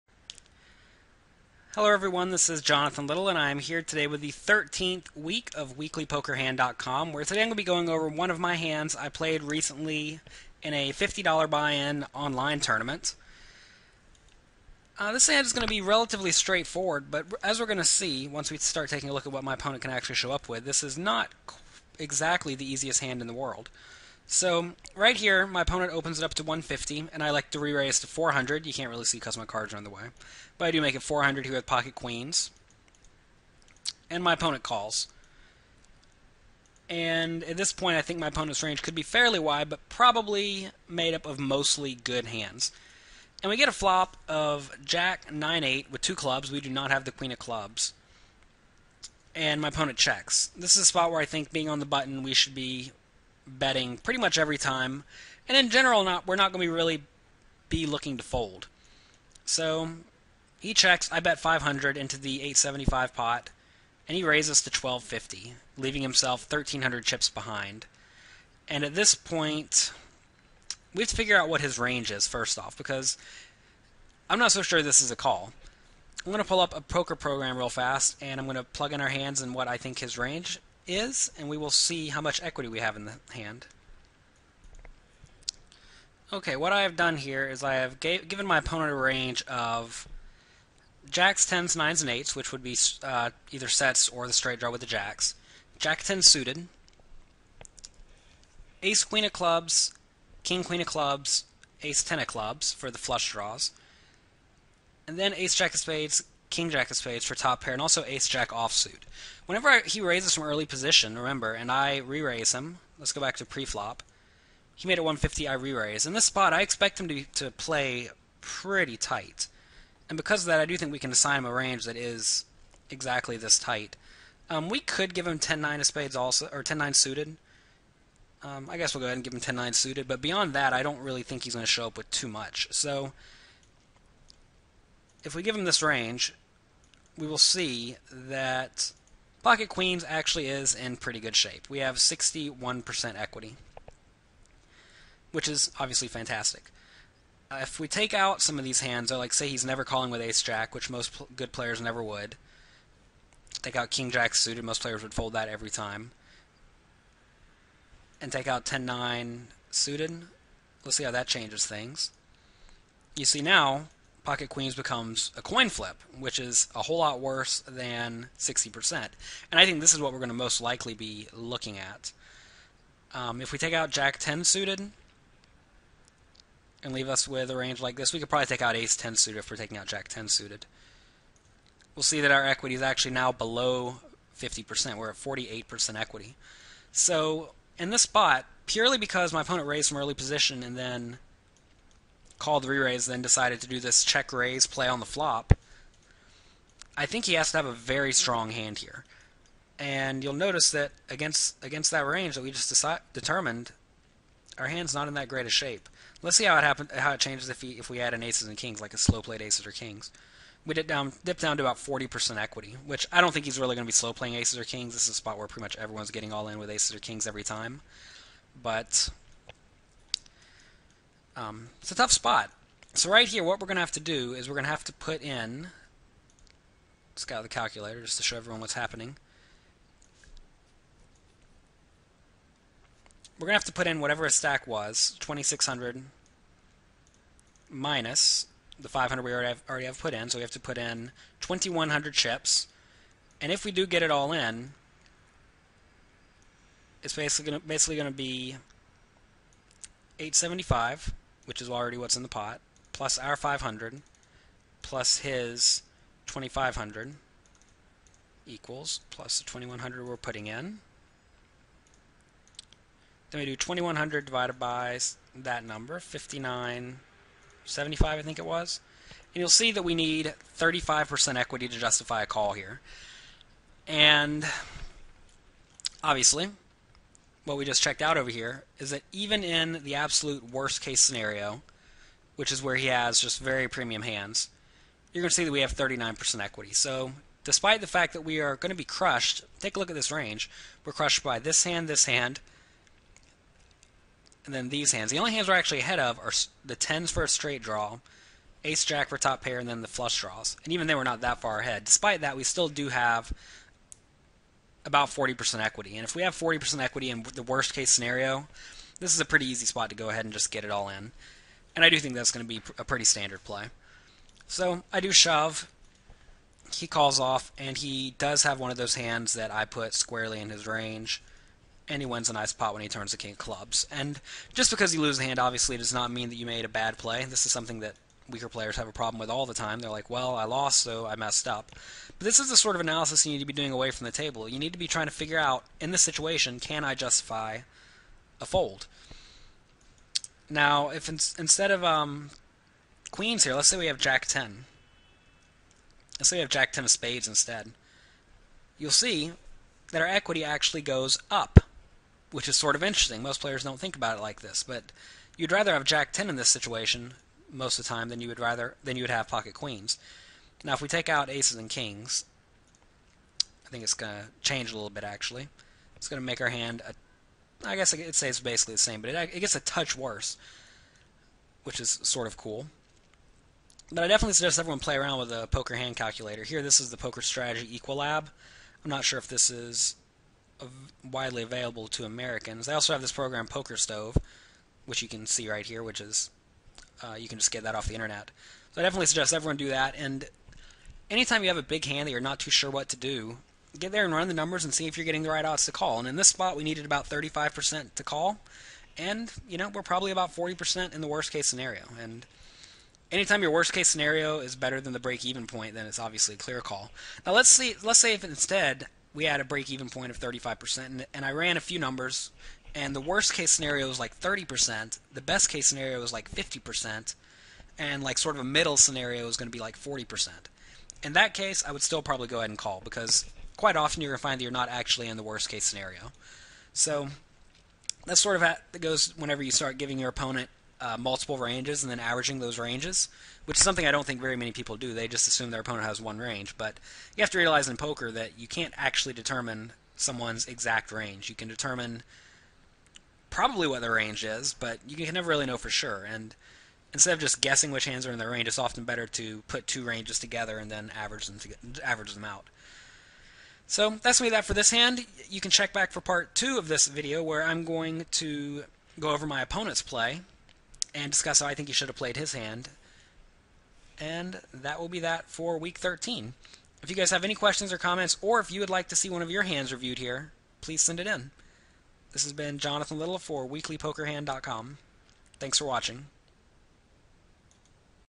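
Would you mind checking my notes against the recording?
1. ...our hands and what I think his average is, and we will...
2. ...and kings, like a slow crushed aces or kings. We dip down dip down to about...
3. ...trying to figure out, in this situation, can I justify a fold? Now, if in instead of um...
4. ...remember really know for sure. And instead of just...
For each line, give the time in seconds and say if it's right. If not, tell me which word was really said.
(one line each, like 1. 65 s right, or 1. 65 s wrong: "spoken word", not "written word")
1. 79 s wrong: "range", not "average"
2. 208 s wrong: "played", not "crushed"
3. 334 s right
4. 445 s wrong: "never", not "remember".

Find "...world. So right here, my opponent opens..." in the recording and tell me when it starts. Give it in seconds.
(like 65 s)
23 s.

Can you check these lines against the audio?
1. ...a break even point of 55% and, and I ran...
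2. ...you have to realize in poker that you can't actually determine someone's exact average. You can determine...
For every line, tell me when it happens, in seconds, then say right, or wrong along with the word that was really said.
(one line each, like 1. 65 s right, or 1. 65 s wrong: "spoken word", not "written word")
1. 409 s wrong: "35", not "55"
2. 437 s wrong: "range", not "average".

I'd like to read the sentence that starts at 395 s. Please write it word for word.
And in this spot, we needed about 35% to call.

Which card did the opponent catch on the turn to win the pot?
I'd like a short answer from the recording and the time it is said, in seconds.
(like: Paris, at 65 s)
King of clubs, at 323 s.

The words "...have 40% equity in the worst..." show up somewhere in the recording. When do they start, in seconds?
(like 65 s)
306 s.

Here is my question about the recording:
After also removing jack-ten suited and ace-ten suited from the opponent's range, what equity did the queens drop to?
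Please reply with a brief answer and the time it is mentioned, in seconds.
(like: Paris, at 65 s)
48%, at 185 s.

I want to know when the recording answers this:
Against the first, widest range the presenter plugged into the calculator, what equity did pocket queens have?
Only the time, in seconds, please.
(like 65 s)
141 s.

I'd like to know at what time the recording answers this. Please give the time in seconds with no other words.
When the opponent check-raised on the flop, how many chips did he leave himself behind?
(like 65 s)
66 s.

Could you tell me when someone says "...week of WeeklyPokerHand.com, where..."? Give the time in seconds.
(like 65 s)
5 s.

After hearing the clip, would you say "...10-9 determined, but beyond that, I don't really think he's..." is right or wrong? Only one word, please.
wrong.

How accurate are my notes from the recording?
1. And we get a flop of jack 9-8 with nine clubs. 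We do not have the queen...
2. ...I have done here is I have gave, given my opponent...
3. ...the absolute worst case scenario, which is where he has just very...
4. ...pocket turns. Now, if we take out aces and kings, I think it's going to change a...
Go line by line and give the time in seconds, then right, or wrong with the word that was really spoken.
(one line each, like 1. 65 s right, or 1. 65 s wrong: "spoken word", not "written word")
1. 43 s wrong: "two", not "nine"
2. 86 s right
3. 279 s right
4. 359 s wrong: "queens", not "turns".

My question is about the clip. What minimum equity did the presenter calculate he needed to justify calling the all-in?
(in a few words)
35%.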